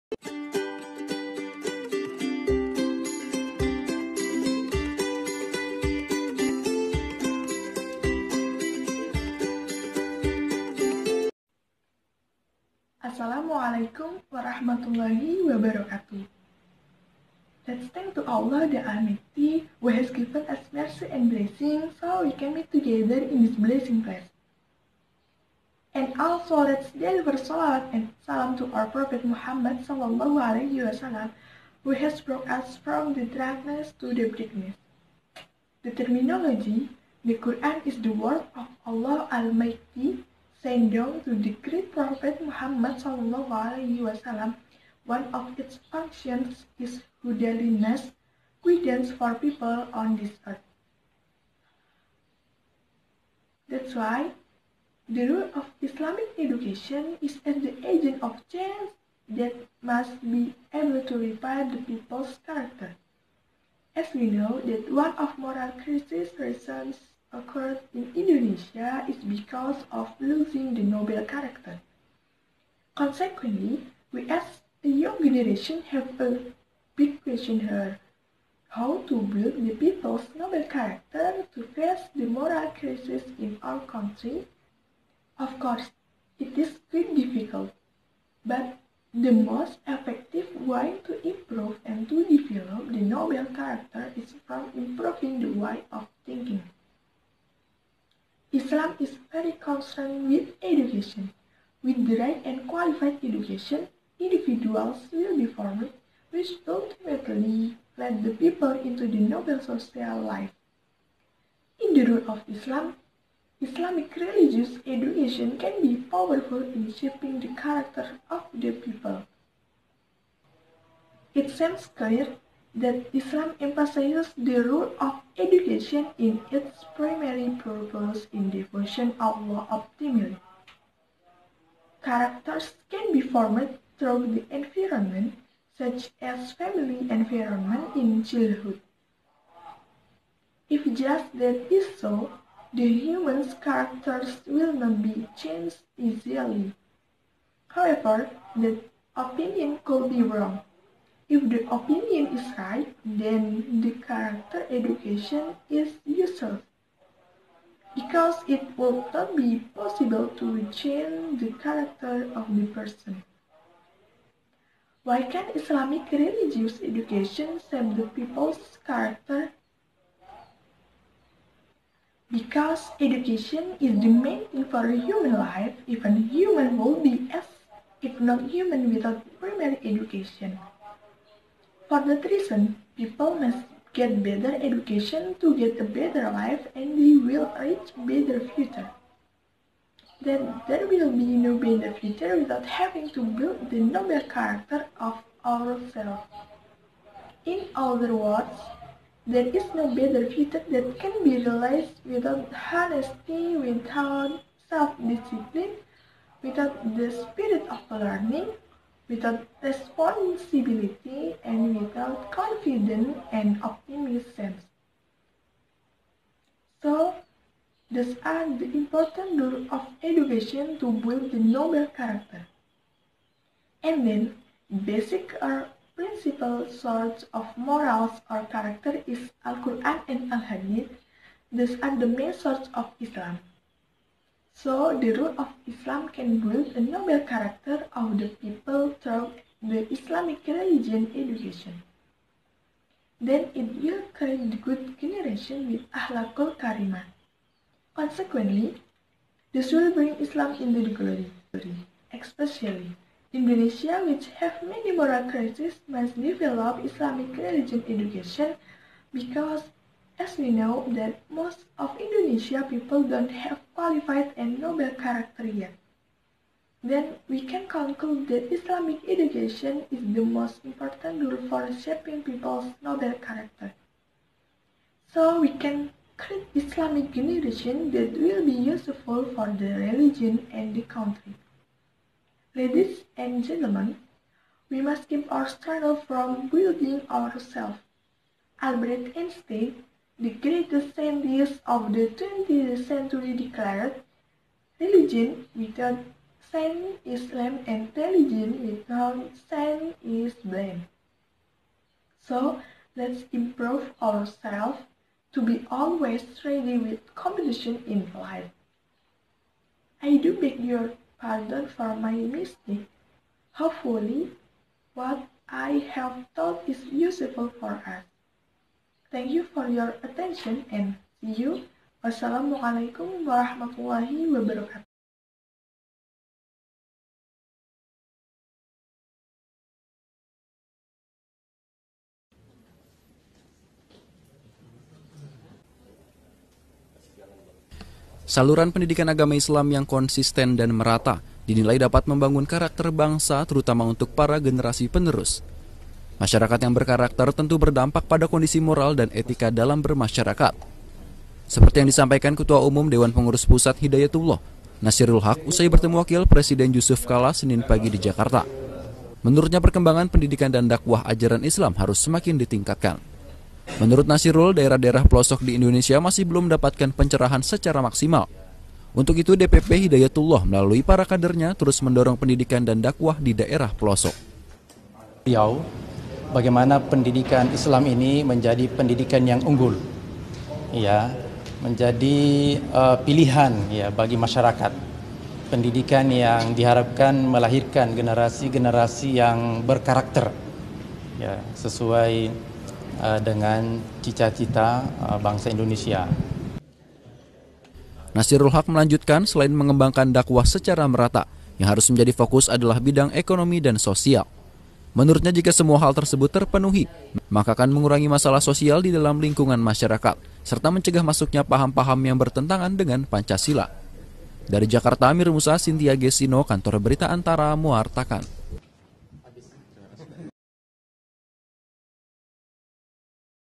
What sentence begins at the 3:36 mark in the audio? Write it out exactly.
So, these are the important role of education to build the noble character.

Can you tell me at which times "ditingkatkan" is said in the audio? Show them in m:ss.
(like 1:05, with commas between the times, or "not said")
6:02.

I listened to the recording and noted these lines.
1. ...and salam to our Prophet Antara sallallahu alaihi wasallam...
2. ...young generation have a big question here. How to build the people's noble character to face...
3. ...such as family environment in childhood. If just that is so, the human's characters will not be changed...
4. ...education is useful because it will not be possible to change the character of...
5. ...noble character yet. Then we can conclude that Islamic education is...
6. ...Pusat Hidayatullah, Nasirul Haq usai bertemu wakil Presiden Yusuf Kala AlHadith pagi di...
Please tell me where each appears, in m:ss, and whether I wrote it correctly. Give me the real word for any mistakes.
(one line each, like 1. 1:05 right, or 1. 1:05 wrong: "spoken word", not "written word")
1. 0:27 wrong: "Muhammad", not "Antara"
2. 1:14 right
3. 2:15 right
4. 2:34 right
5. 4:24 right
6. 5:53 wrong: "Senin", not "AlHadith".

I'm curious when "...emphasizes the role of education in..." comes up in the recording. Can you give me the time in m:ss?
2:03.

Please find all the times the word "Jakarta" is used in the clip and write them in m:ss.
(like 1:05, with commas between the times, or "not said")
5:57, 6:54.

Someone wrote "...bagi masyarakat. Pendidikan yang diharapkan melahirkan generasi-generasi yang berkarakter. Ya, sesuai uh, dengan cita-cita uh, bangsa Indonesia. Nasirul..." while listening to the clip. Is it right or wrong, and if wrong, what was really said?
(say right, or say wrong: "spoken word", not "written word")
right.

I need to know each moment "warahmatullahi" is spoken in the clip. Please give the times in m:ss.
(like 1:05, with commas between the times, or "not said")
0:14, 5:23.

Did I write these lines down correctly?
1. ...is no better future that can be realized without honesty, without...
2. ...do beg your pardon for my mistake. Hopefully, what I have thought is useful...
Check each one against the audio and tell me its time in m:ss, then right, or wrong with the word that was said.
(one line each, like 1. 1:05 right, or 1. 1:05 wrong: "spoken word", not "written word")
1. 3:19 right
2. 5:10 right.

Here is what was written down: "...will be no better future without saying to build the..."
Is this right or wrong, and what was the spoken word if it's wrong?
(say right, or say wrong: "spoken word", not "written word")
wrong: "having", not "saying".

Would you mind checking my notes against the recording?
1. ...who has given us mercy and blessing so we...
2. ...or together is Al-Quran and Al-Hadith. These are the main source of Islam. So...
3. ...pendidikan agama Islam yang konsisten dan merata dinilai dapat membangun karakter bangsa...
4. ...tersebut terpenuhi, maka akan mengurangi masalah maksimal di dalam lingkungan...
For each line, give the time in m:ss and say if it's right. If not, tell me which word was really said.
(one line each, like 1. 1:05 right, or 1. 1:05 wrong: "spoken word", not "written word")
1. 0:19 right
2. 3:48 wrong: "character", not "together"
3. 5:38 right
4. 6:45 wrong: "sosial", not "maksimal".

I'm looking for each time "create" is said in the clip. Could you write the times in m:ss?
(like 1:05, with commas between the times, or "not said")
4:04, 4:36.